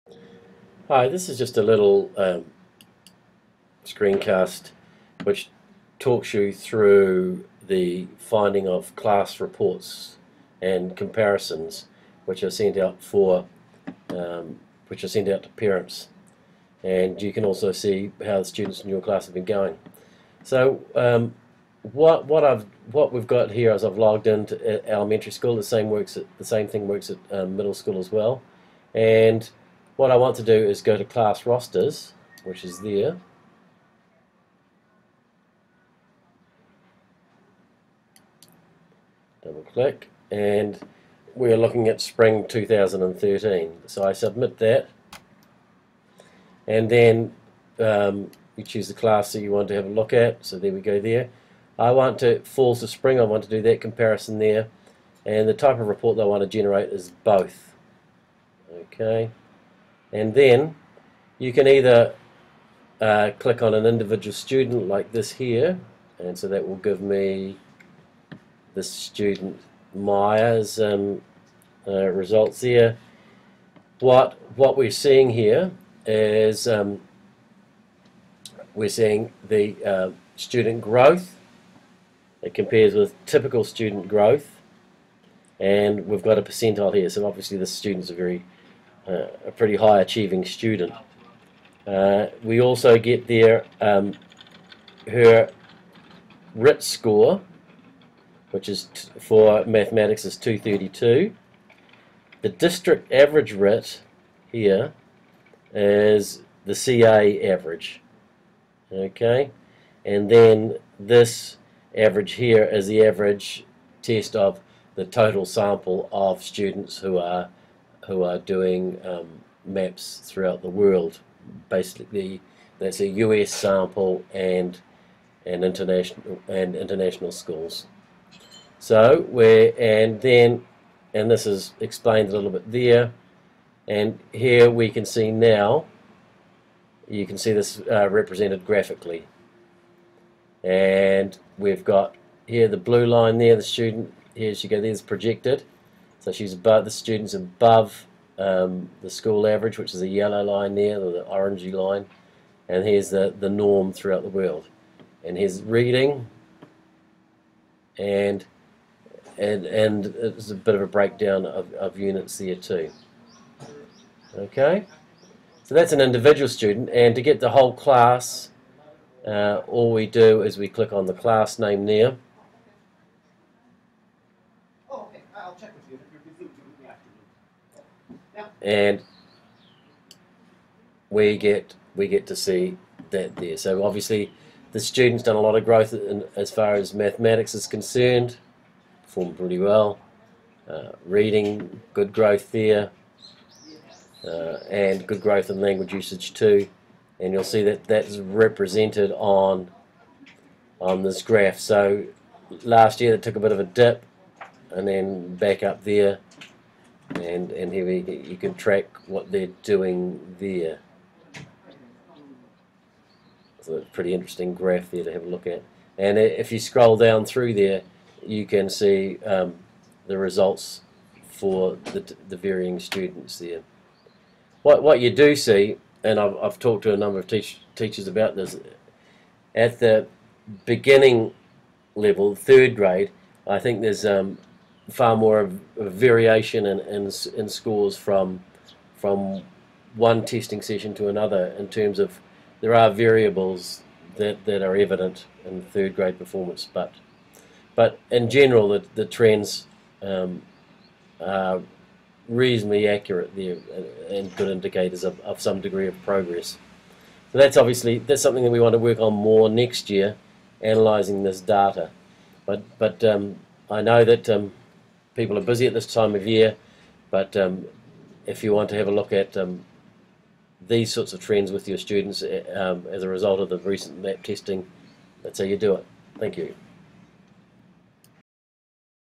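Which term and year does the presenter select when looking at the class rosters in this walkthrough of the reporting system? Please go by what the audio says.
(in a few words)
Spring 2013.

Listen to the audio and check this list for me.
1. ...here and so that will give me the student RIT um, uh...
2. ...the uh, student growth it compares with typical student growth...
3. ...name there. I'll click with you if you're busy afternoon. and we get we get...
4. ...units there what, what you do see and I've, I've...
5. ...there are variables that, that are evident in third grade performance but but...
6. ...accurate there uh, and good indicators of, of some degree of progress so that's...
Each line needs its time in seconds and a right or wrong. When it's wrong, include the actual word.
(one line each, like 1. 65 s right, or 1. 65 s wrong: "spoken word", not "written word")
1. 65 s wrong: "Myers", not "RIT"
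2. 79 s right
3. 171 s wrong: "check", not "click"
4. 222 s wrong: "students", not "units"
5. 242 s right
6. 252 s right.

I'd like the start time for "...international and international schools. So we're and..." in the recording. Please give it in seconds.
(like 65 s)
125 s.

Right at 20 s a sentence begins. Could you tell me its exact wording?
So um, what what I've what we've got here is I've logged into uh, elementary school.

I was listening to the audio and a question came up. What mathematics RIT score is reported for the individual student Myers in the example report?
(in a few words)
232.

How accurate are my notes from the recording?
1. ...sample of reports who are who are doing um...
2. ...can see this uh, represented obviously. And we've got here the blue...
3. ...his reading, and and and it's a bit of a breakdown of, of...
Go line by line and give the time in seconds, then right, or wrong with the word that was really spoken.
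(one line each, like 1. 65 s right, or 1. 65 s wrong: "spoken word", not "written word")
1. 115 s wrong: "students", not "reports"
2. 137 s wrong: "graphically", not "obviously"
3. 155 s right.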